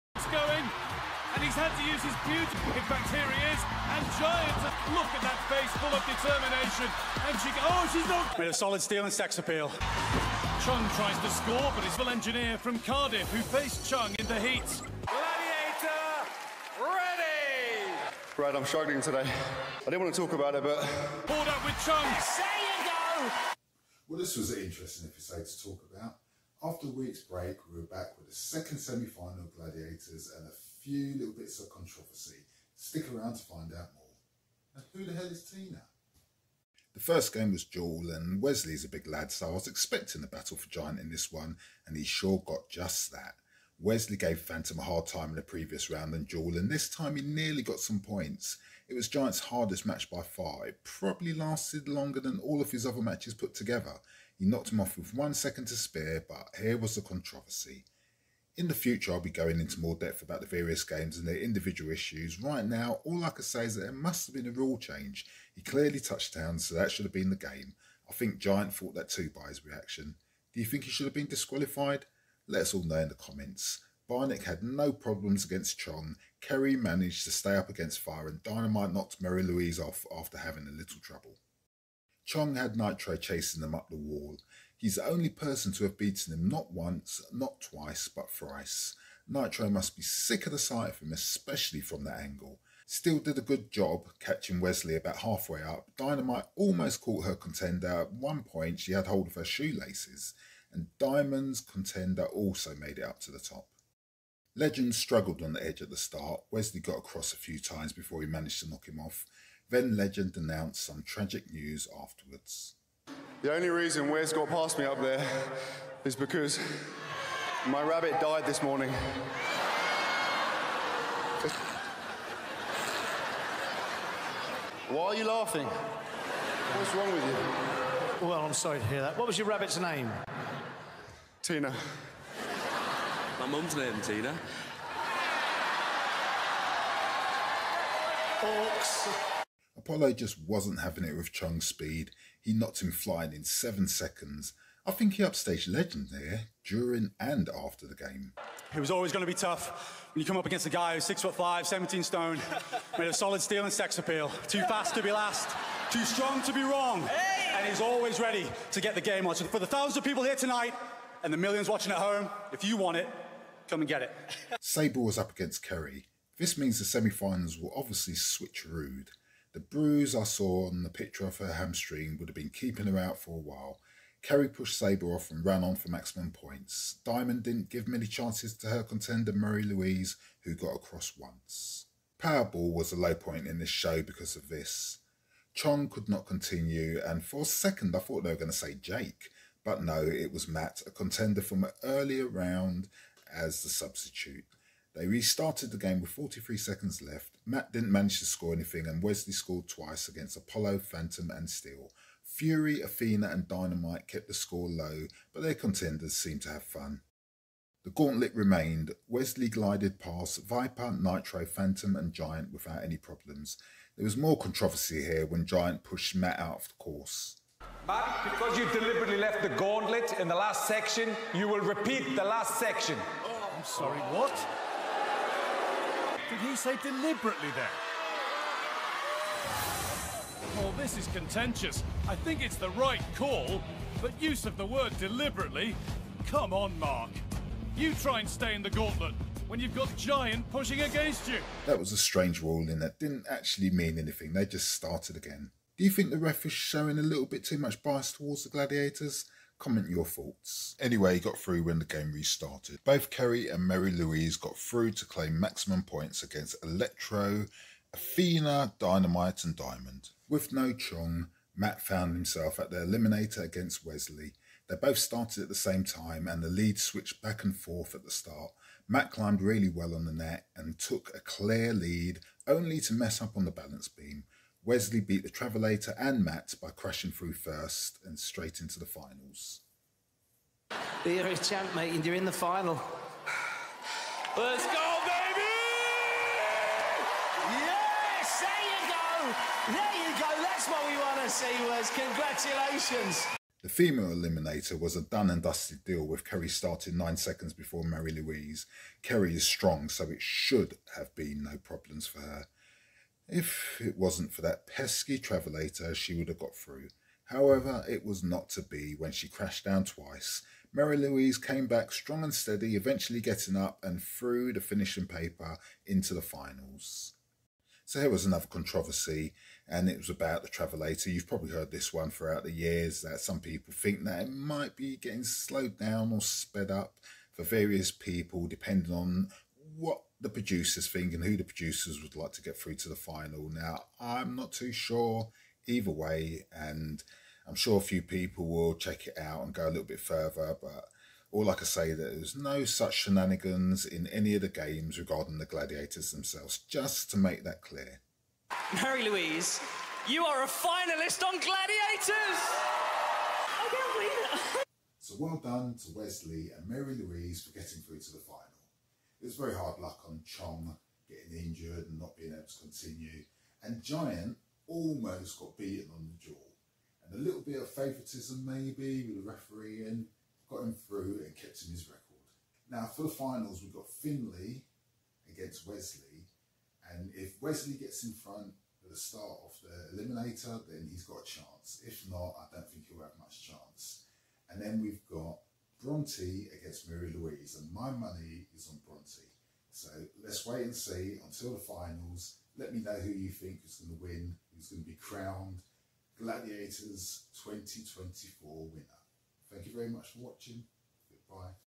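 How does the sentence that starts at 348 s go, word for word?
Mary Louise, you are a finalist on Gladiators!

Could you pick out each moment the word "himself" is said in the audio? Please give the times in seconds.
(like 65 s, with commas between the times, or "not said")
262 s.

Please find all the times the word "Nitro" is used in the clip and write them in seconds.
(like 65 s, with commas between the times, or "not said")
82 s, 89 s, 210 s.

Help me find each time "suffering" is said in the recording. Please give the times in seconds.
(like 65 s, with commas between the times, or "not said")
not said.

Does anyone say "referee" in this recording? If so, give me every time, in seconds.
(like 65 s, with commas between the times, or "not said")
369 s.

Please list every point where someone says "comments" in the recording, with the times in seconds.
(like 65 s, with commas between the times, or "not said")
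73 s, 249 s.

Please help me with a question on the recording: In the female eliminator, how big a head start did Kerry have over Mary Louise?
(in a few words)
9 seconds.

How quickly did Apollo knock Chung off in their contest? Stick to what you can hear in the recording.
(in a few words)
7 seconds.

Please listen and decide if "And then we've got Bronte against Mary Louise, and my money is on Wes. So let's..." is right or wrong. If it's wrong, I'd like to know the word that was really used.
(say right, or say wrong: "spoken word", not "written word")
wrong: "Bronte", not "Wes".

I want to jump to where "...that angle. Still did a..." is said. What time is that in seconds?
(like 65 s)
92 s.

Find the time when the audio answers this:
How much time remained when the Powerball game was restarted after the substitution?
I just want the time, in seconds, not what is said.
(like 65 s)
196 s.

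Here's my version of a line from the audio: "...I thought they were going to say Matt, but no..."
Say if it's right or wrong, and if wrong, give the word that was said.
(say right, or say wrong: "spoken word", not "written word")
wrong: "Jake", not "Matt".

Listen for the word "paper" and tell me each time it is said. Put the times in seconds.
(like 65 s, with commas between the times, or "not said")
315 s.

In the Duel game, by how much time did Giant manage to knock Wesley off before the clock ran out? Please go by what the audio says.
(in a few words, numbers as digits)
1 second.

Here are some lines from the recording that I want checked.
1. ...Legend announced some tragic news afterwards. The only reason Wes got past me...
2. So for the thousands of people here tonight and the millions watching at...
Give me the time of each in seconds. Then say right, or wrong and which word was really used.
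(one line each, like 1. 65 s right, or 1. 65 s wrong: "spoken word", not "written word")
1. 109 s right
2. 159 s right.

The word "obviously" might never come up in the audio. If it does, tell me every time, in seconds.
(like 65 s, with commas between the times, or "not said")
167 s.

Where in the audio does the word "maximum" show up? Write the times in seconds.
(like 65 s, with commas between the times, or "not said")
175 s, 255 s.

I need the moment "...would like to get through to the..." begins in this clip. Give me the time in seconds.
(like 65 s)
332 s.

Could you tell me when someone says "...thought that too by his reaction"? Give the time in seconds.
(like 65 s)
68 s.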